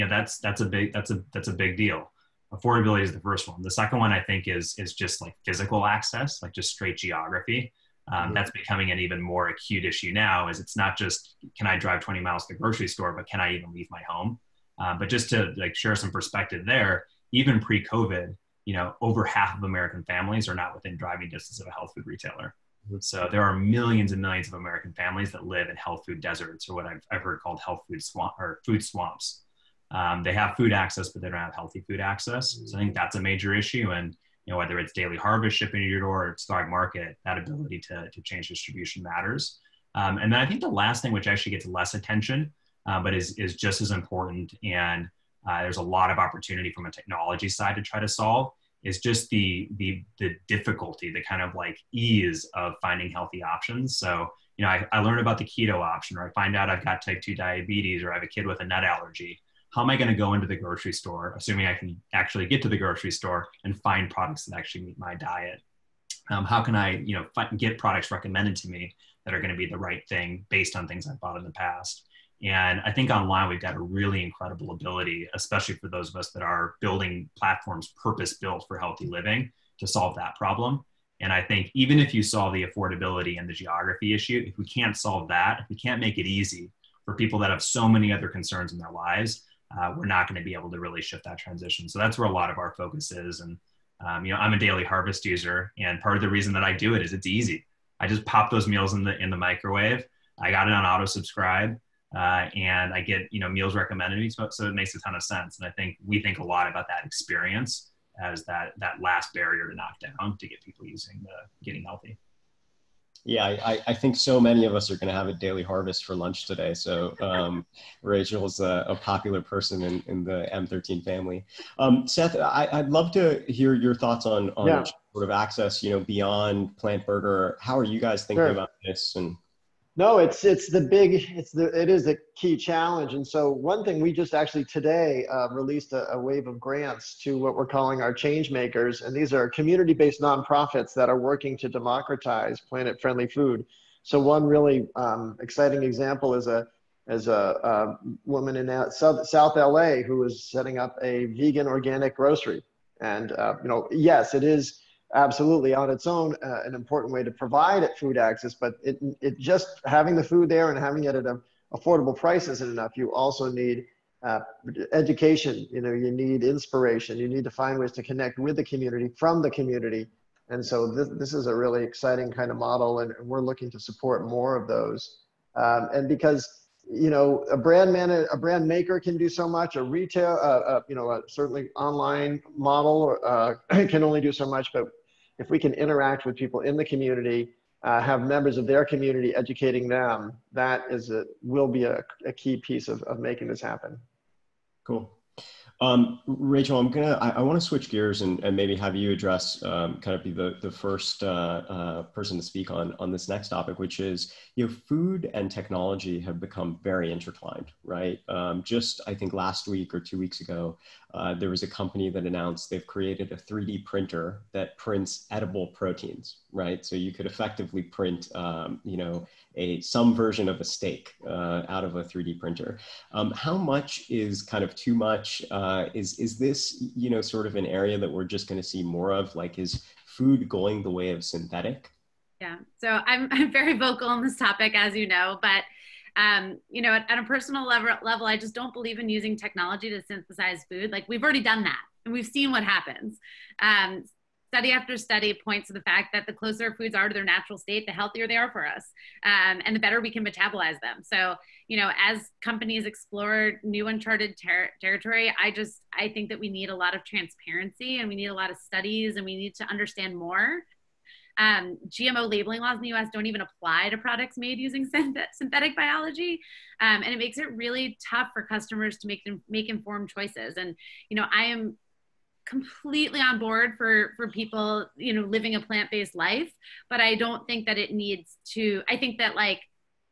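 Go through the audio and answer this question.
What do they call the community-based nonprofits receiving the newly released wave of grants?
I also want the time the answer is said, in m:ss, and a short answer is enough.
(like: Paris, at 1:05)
change makers, at 2:18.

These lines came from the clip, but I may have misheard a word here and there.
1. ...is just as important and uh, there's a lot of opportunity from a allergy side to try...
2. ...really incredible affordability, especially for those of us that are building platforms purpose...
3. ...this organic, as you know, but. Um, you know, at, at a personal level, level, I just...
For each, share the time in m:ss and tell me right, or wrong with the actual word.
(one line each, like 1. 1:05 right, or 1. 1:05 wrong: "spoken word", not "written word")
1. 0:43 wrong: "technology", not "allergy"
2. 1:13 wrong: "ability", not "affordability"
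3. 3:54 wrong: "topic", not "organic".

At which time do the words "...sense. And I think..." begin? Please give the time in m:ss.
1:45.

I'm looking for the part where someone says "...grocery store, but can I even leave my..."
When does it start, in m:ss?
0:12.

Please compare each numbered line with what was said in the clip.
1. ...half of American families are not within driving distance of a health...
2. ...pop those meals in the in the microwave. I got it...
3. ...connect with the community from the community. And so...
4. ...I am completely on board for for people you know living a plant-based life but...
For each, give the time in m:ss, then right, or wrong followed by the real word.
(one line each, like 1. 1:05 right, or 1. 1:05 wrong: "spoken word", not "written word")
1. 0:19 right
2. 1:38 right
3. 2:48 right
4. 4:31 right.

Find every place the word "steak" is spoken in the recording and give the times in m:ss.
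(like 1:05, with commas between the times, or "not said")
3:40.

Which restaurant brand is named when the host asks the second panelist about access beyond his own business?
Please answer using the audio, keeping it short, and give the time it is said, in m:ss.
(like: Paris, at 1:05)
PLNT Burger, at 2:06.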